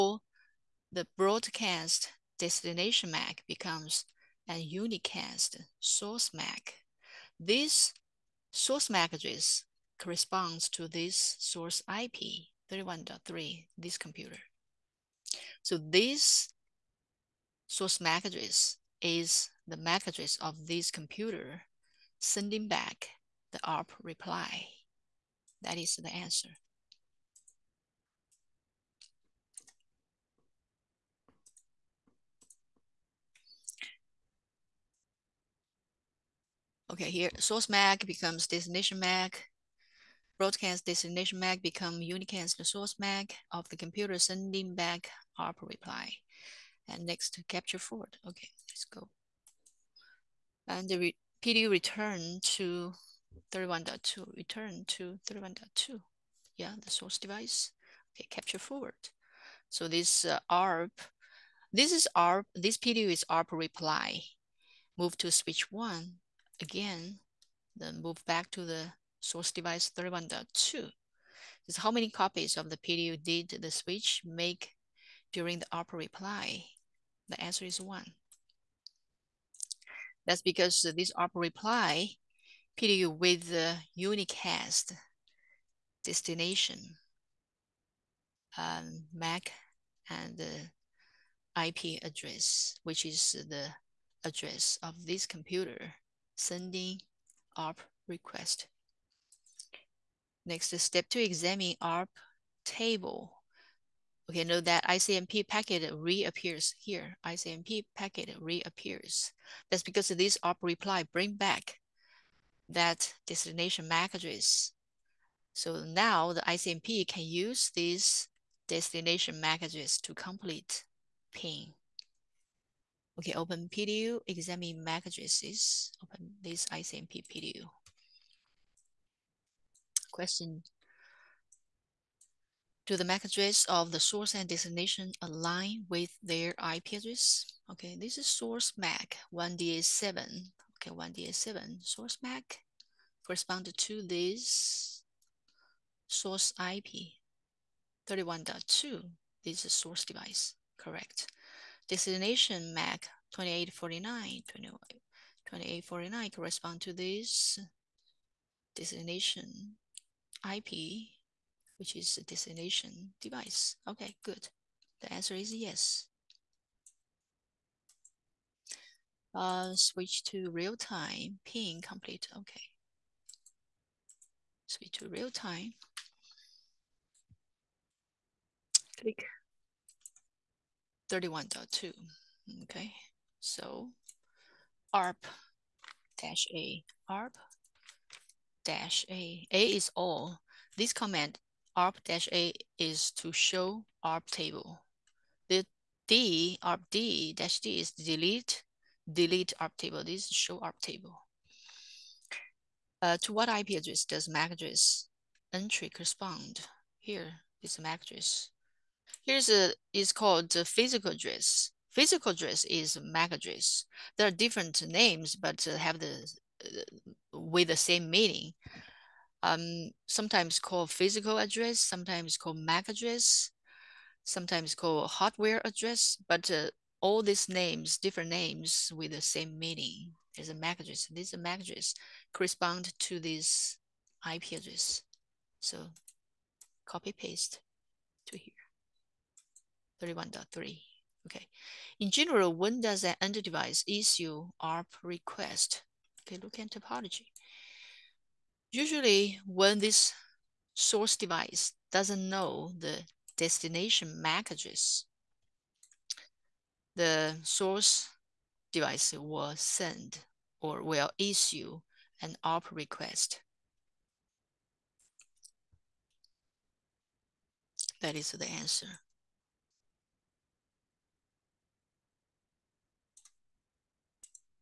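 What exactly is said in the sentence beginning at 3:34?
There are different names, but have the uh, with the same meaning.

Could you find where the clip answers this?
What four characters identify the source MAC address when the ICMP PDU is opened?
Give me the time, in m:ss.
2:18.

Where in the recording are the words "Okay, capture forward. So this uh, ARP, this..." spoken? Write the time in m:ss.
0:58.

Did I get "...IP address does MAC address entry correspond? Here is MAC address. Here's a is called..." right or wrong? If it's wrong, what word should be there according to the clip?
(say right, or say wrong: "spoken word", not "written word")
right.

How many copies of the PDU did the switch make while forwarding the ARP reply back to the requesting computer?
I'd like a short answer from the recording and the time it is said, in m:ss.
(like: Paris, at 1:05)
1, at 1:17.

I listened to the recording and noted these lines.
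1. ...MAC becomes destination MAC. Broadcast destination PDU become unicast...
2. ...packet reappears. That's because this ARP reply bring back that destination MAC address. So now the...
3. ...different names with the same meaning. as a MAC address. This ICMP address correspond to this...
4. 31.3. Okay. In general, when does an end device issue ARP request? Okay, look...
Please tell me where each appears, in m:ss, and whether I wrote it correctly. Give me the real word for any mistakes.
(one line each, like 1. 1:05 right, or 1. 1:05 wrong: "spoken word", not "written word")
1. 0:37 wrong: "MAC", not "PDU"
2. 1:47 right
3. 3:47 wrong: "MAC", not "ICMP"
4. 4:00 right.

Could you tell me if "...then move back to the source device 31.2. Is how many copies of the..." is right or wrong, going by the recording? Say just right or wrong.
right.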